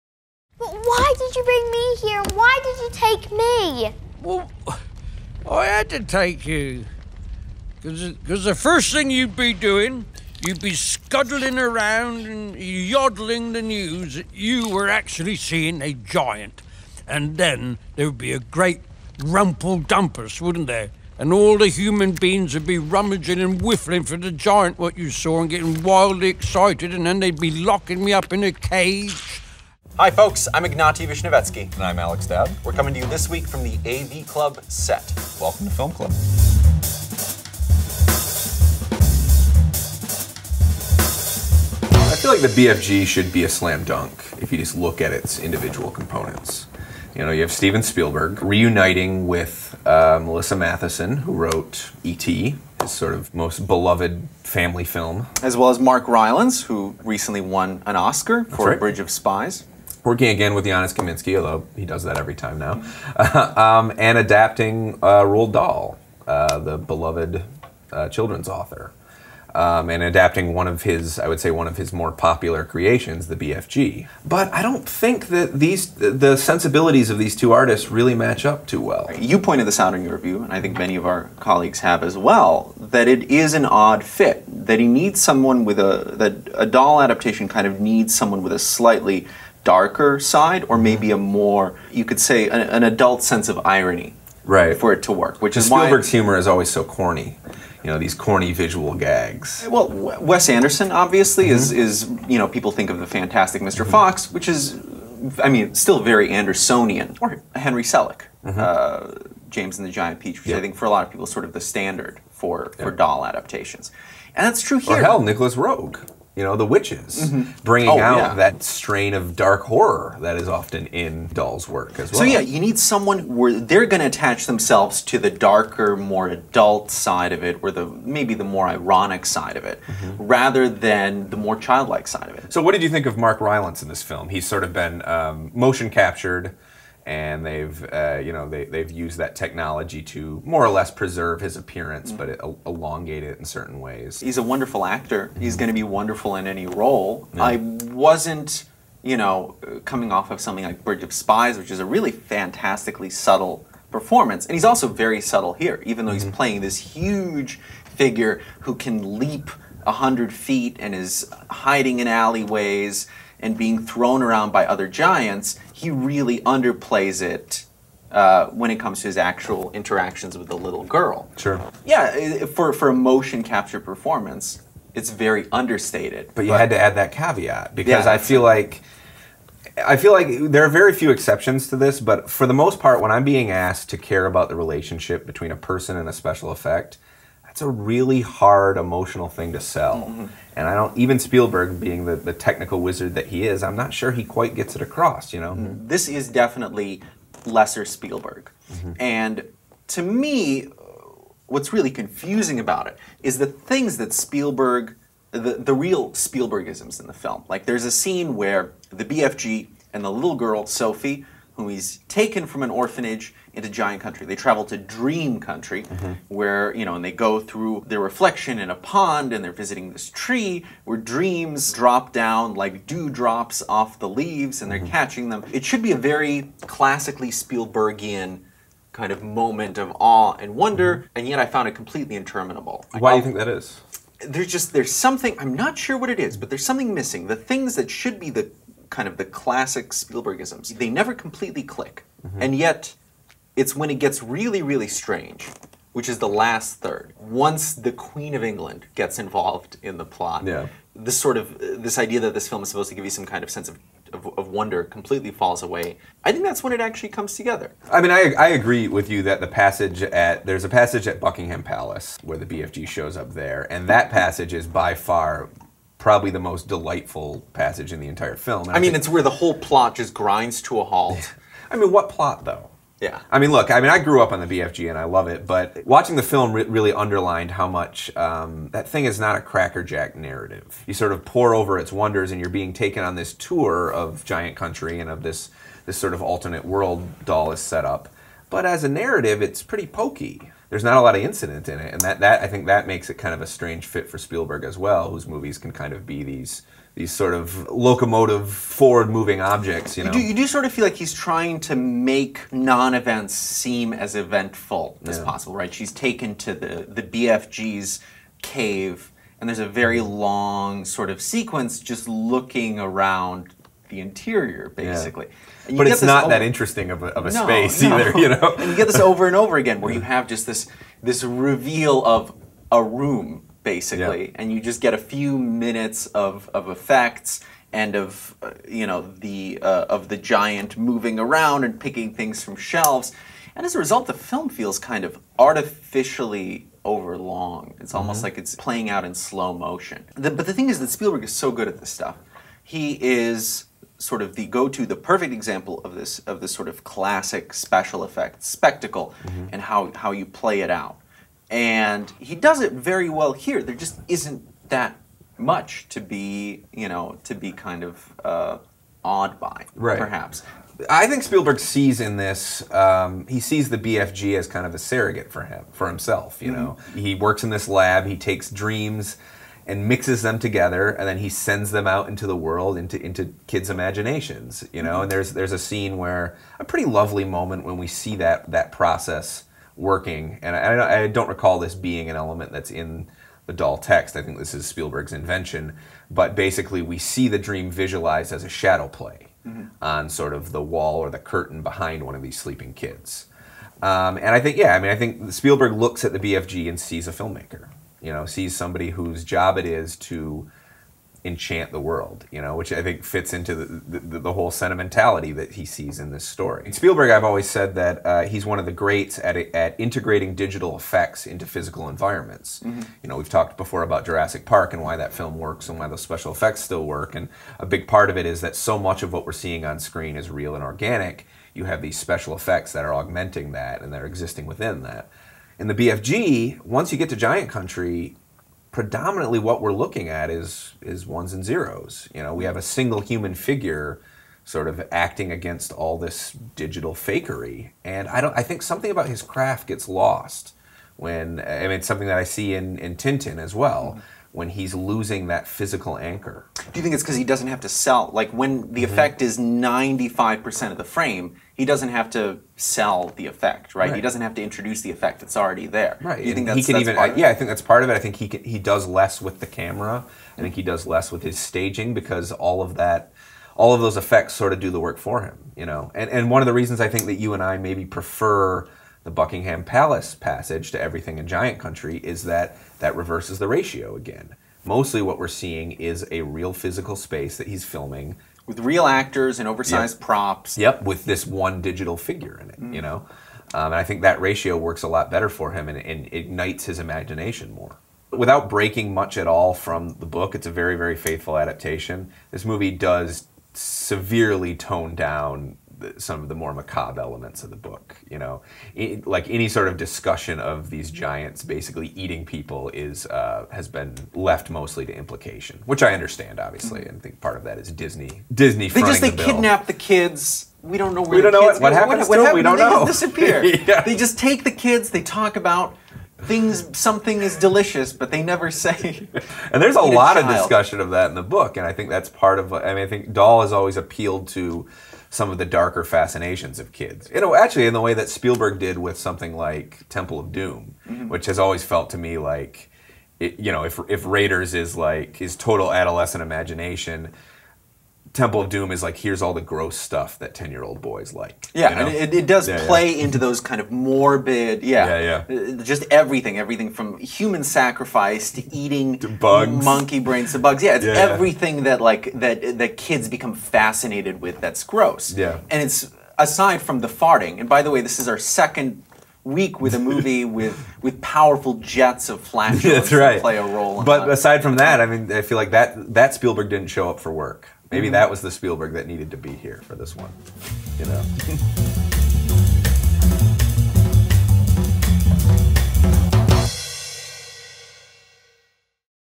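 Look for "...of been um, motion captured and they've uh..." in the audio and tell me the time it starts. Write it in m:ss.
2:14.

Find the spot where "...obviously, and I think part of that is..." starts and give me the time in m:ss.
8:26.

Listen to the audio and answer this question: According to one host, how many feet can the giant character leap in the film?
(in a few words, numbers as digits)
100.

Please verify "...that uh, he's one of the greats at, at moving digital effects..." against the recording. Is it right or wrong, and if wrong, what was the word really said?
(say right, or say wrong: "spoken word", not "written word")
wrong: "integrating", not "moving".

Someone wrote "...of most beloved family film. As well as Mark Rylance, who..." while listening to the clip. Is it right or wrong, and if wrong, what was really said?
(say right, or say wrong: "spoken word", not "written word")
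right.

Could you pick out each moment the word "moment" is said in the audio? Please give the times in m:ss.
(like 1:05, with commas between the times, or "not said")
3:49, 6:17.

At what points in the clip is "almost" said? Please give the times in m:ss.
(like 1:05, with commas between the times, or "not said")
5:37.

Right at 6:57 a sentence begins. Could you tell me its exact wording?
And a big part of it is that so much of what we're seeing on screen is real and organic.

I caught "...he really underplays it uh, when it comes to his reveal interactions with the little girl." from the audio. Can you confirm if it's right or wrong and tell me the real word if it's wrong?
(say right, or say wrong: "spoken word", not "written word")
wrong: "actual", not "reveal".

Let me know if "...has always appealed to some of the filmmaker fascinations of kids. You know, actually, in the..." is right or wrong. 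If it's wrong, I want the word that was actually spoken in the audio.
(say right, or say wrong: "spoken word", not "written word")
wrong: "darker", not "filmmaker".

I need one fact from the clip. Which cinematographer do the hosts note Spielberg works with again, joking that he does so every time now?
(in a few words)
Janusz Kaminski.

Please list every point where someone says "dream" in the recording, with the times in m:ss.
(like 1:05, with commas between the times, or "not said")
3:34, 3:41, 6:08, 6:27.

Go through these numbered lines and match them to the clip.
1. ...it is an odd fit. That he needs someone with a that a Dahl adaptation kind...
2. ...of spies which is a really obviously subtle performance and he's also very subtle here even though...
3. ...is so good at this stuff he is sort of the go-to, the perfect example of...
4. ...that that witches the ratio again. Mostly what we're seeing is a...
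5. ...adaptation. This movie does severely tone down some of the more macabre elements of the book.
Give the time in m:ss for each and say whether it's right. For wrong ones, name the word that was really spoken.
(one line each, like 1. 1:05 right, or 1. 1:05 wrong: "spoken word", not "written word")
1. 1:23 right
2. 2:31 wrong: "fantastically", not "obviously"
3. 5:41 right
4. 7:52 wrong: "reverses", not "witches"
5. 8:11 right.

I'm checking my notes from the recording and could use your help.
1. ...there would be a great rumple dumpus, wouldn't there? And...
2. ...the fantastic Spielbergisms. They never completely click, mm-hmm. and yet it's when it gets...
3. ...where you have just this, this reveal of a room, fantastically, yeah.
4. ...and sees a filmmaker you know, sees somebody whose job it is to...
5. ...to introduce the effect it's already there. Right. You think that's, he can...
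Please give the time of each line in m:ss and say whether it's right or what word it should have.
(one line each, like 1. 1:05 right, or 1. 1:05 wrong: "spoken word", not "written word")
1. 0:17 right
2. 3:59 wrong: "classic", not "fantastic"
3. 5:19 wrong: "basically", not "fantastically"
4. 6:36 right
5. 7:34 right.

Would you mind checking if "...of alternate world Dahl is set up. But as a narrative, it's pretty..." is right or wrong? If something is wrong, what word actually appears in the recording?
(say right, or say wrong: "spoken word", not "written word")
right.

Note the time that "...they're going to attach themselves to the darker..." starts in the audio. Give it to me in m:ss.
2:03.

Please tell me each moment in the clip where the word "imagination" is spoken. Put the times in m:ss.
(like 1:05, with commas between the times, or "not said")
6:13, 8:06, 8:56.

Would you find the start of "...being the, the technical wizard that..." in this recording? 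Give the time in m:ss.
3:11.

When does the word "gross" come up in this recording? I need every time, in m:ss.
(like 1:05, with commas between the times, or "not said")
8:59, 9:14.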